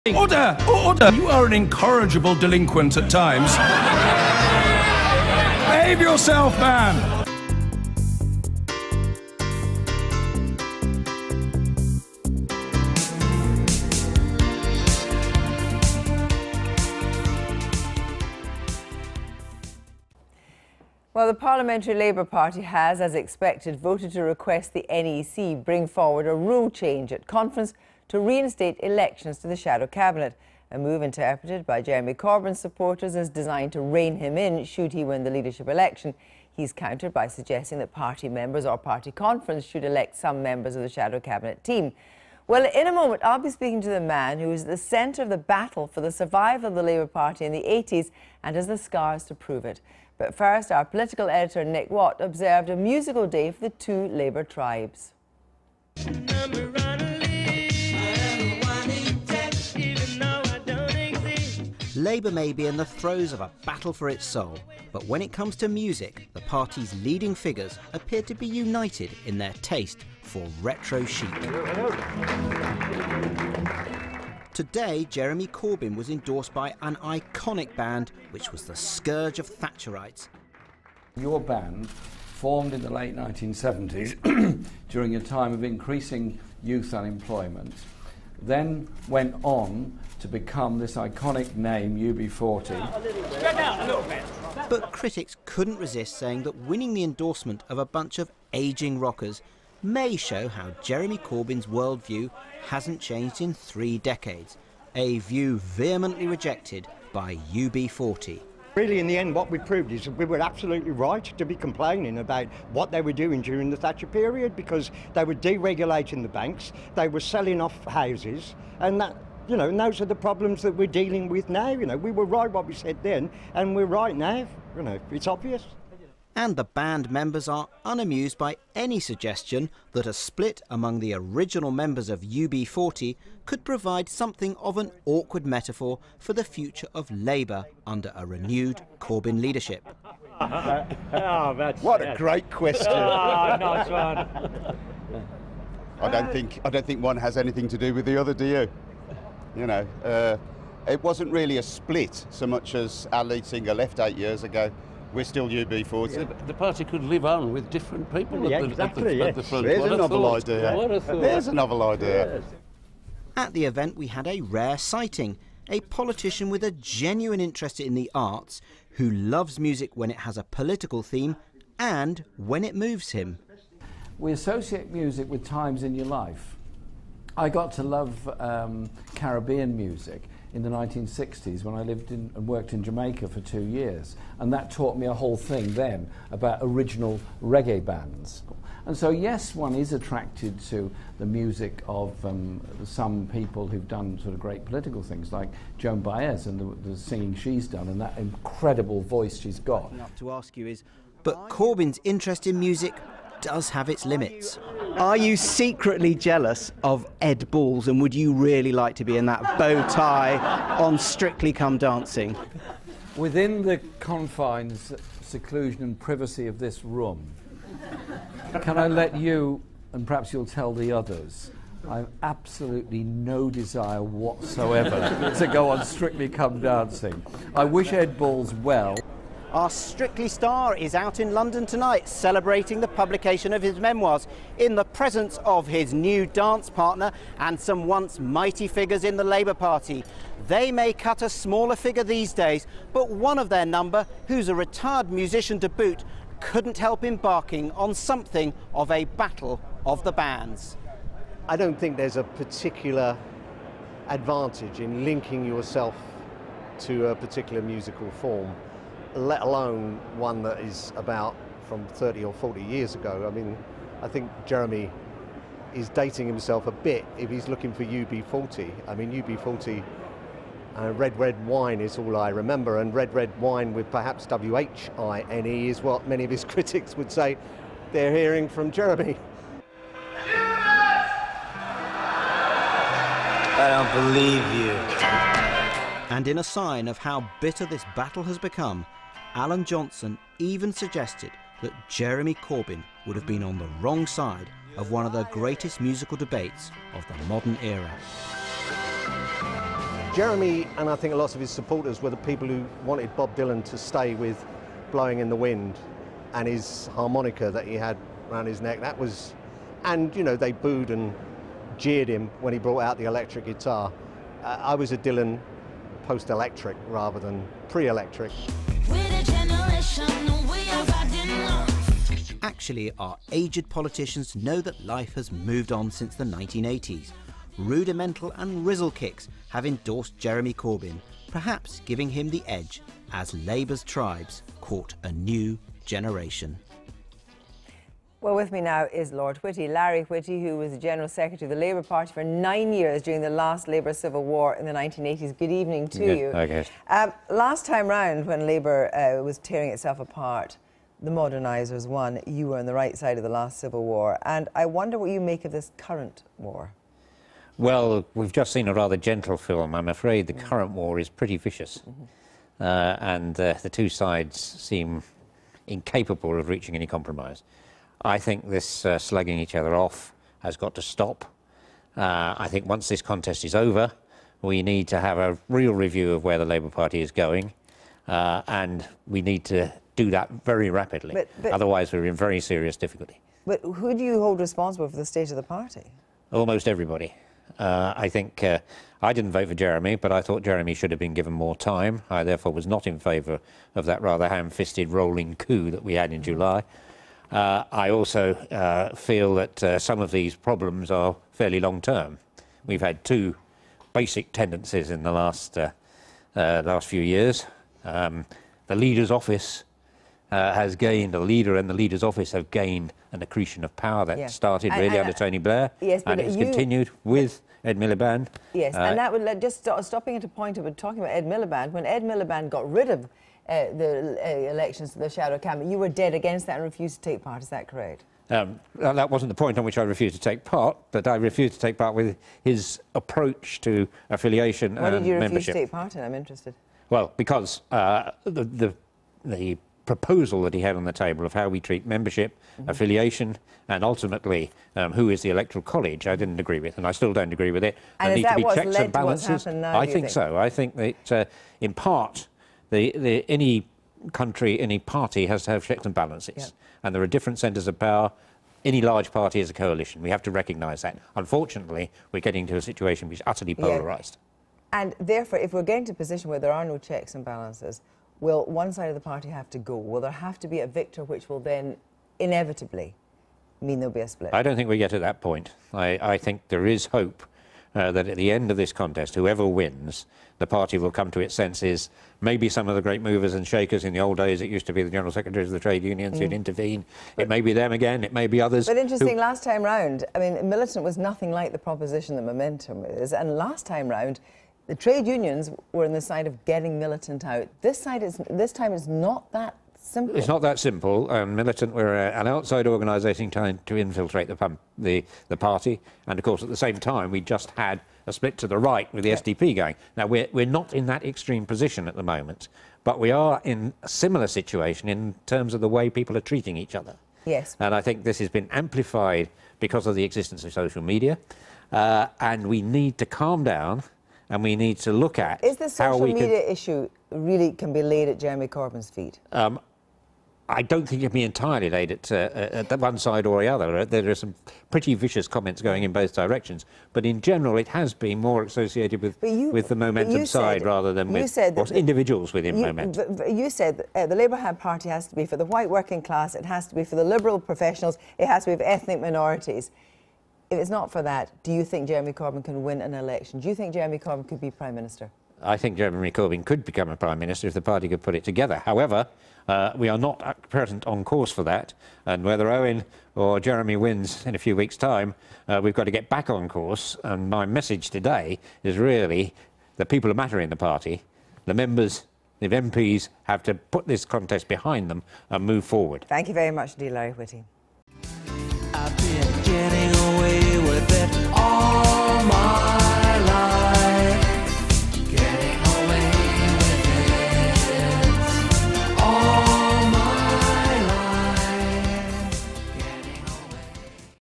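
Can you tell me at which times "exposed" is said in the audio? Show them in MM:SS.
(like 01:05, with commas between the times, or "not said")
not said.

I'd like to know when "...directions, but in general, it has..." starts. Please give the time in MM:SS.
08:56.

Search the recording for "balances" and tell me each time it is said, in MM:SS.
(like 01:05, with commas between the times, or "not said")
07:28, 07:35, 07:47.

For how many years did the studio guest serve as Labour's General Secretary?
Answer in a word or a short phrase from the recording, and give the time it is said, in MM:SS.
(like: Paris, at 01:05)
9, at 05:42.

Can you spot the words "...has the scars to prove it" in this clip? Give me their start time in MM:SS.
00:48.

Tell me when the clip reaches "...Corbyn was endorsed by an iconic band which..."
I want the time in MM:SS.
01:15.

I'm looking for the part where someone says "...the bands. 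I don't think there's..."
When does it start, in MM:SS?
04:10.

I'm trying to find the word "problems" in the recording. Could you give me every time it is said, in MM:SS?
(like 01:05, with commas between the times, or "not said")
02:00, 06:40.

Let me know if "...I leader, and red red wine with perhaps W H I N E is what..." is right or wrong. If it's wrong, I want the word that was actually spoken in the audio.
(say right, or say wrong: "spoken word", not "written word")
wrong: "remember", not "leader".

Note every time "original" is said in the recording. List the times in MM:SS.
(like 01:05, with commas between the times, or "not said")
02:11, 03:06.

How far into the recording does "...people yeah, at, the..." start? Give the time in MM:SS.
02:38.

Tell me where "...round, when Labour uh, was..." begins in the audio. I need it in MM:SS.
05:47.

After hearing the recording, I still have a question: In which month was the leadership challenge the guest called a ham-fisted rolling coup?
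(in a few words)
July.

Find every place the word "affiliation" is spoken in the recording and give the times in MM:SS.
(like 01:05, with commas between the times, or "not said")
07:14, 07:22.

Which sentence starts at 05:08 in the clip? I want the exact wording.
That was, and you know, they booed and jeered him when he brought out the electric guitar.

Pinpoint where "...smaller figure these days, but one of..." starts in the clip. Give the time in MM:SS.
04:01.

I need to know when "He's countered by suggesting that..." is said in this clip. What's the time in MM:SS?
00:36.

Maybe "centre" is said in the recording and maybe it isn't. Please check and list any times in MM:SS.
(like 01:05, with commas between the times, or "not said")
00:44, 07:37.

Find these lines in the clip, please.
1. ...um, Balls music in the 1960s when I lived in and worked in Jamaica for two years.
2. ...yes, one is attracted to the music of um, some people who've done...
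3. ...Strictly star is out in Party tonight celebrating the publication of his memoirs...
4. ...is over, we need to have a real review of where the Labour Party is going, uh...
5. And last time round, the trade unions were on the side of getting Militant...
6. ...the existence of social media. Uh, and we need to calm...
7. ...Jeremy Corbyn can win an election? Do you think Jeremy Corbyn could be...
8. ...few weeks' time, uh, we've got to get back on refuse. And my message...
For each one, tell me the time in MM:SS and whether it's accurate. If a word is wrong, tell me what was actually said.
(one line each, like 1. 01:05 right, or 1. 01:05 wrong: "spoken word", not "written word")
1. 02:58 wrong: "Caribbean", not "Balls"
2. 03:09 right
3. 03:49 wrong: "London", not "Party"
4. 06:13 right
5. 08:13 right
6. 08:39 right
7. 09:11 right
8. 09:24 wrong: "course", not "refuse".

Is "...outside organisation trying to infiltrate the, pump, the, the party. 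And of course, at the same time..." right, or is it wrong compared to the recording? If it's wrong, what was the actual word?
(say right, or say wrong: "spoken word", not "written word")
right.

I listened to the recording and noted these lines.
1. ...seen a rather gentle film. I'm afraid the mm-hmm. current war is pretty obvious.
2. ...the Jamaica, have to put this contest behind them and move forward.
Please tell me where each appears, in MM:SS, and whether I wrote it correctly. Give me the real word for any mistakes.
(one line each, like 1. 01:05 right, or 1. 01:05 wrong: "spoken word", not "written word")
1. 05:58 wrong: "vicious", not "obvious"
2. 09:32 wrong: "MPs", not "Jamaica".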